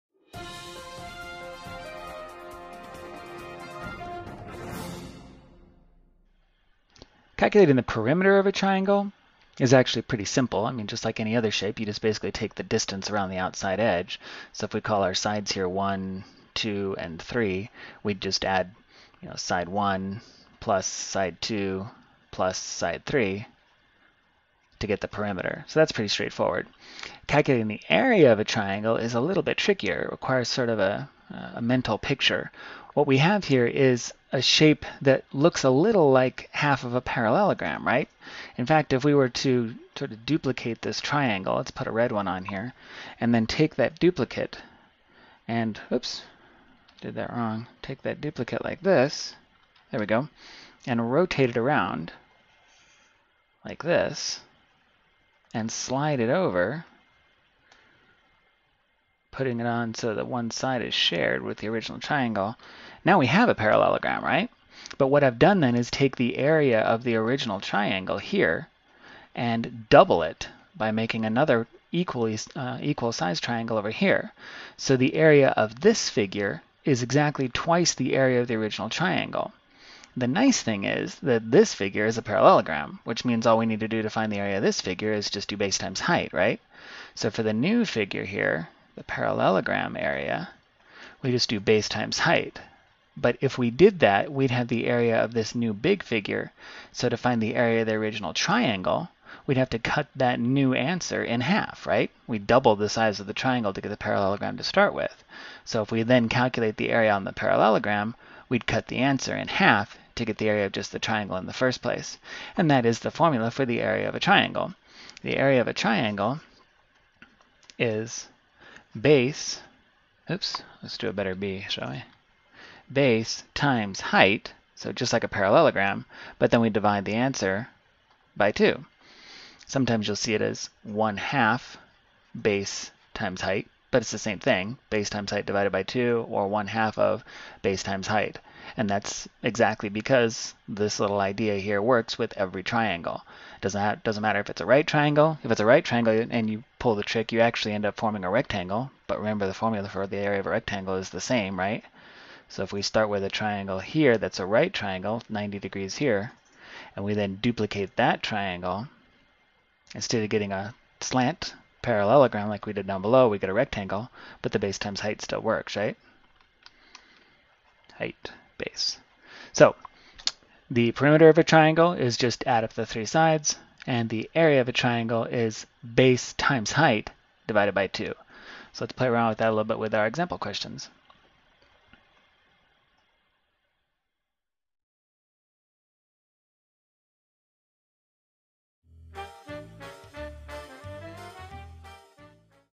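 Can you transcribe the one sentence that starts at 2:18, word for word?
And that's exactly because this little idea here works with every triangle.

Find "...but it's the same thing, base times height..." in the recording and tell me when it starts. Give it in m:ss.
2:13.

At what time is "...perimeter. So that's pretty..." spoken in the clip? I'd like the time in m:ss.
0:25.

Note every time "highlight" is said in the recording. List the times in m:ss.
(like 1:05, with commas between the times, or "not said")
not said.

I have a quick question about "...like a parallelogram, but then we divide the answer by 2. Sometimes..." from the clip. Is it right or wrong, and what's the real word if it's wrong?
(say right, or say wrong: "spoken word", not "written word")
right.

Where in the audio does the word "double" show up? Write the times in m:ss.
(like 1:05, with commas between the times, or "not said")
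1:09, 1:42.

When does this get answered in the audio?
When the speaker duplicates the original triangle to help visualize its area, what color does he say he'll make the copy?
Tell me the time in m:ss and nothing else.
0:41.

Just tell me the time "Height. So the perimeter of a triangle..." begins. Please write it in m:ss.
2:47.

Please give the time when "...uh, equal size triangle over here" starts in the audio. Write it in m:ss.
1:12.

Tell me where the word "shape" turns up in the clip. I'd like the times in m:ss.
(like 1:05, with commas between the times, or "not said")
0:11, 0:34.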